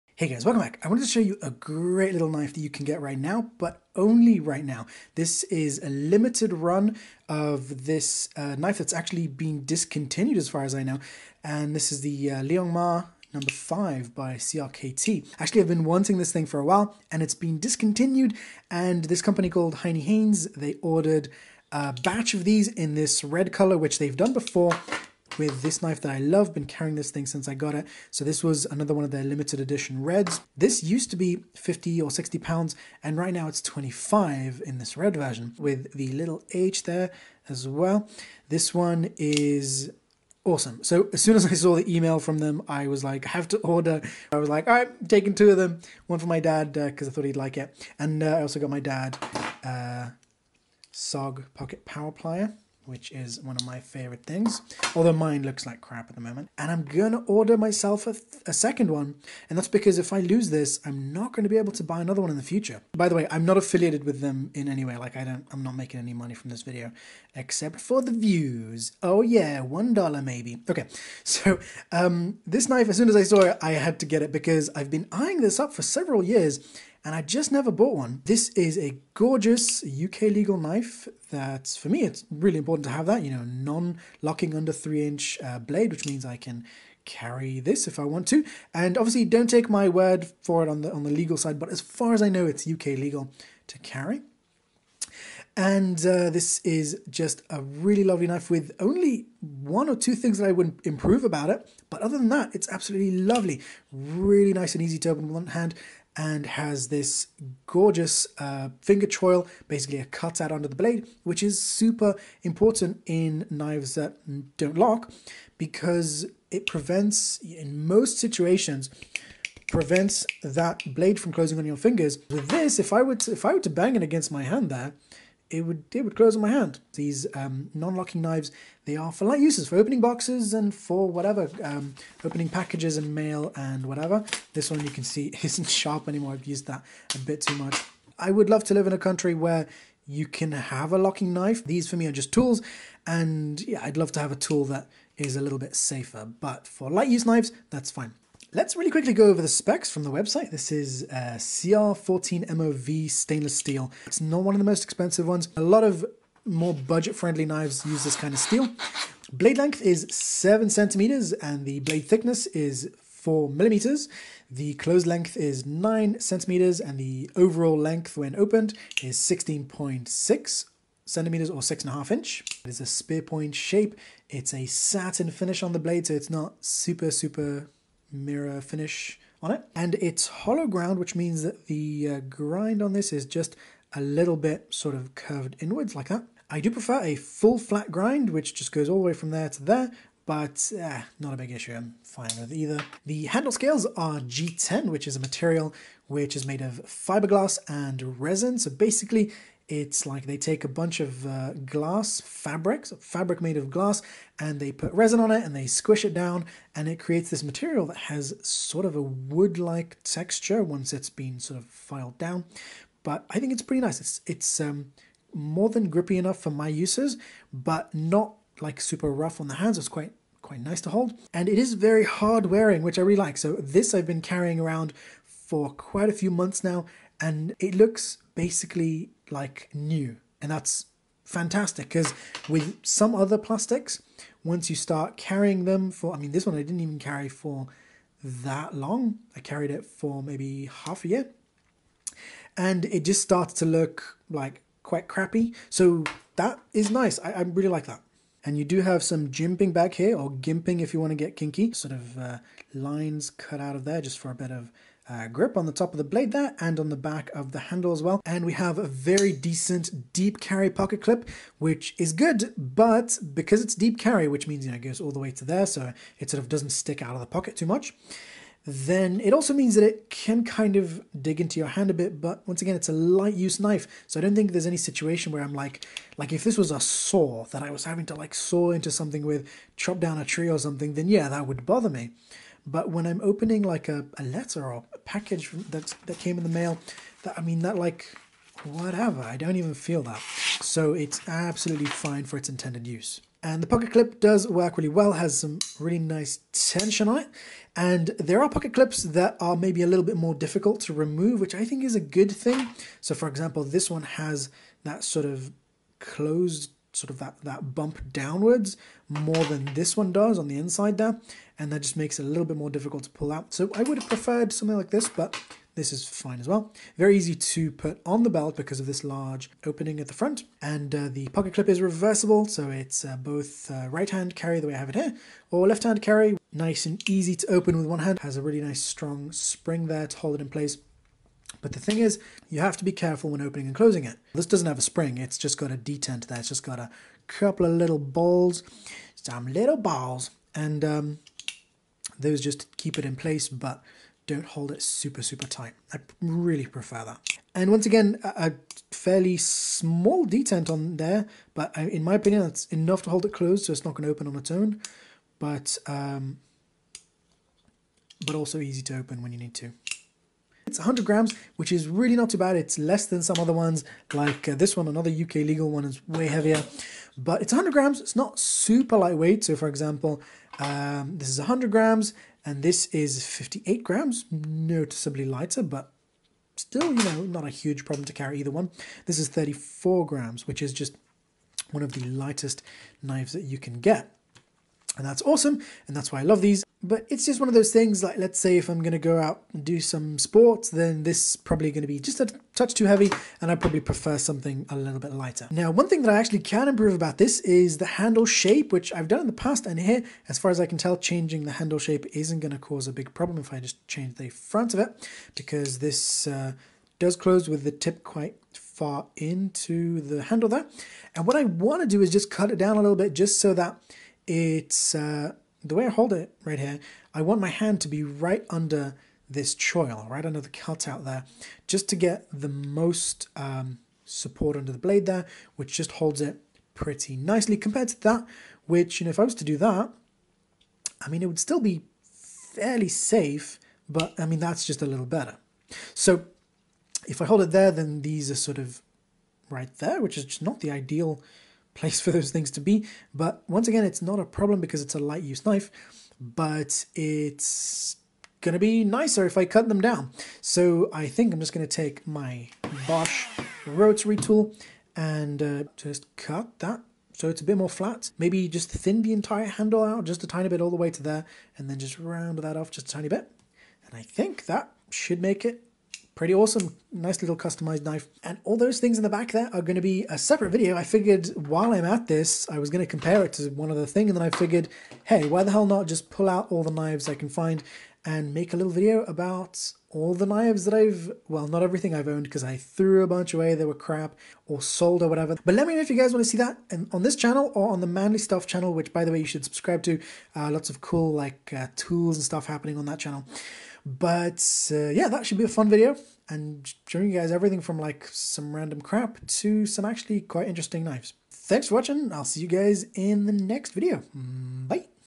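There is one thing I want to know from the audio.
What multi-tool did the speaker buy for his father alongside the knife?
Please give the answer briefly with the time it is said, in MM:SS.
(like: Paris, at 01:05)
SOG pocket power plier, at 00:50.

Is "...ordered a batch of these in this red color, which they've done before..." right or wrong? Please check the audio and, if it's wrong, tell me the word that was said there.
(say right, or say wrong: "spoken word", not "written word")
right.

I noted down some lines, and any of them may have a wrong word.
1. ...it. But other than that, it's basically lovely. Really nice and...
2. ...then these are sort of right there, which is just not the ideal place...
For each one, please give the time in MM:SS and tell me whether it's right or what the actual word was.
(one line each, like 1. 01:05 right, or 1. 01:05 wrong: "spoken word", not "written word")
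1. 01:41 wrong: "absolutely", not "basically"
2. 07:17 right.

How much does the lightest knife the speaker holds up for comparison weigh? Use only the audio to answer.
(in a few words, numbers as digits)
34 grams.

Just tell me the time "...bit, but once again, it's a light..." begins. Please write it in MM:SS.
04:31.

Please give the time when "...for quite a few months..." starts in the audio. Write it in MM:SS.
03:45.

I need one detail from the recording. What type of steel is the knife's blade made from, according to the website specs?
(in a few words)
CR14MOV.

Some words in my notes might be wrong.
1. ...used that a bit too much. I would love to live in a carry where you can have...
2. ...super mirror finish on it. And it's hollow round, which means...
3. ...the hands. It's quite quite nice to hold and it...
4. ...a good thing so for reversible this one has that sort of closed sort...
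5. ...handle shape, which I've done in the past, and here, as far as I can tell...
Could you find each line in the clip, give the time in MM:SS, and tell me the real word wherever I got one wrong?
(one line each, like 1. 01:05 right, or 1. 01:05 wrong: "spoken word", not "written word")
1. 02:16 wrong: "country", not "carry"
2. 02:57 wrong: "ground", not "round"
3. 03:39 right
4. 05:02 wrong: "example", not "reversible"
5. 06:37 right.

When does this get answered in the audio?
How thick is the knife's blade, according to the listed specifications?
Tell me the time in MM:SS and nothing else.
02:43.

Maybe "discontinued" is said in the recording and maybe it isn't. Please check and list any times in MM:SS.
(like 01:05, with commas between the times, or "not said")
00:09, 00:17.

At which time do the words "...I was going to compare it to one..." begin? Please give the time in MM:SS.
07:52.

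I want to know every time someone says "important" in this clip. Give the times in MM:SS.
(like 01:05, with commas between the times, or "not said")
01:22, 01:52.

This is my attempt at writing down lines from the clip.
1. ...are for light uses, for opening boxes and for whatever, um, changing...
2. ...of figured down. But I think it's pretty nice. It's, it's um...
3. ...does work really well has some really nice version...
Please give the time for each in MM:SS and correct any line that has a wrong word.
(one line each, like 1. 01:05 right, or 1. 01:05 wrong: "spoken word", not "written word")
1. 02:08 wrong: "opening", not "changing"
2. 03:31 wrong: "filed", not "figured"
3. 04:54 wrong: "tension", not "version".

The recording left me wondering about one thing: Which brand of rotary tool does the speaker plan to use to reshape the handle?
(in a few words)
Bosch.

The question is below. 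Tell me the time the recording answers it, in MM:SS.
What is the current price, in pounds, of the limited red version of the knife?
00:33.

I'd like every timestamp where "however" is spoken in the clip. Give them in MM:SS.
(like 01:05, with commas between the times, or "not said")
not said.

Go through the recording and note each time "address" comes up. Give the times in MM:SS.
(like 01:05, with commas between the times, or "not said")
not said.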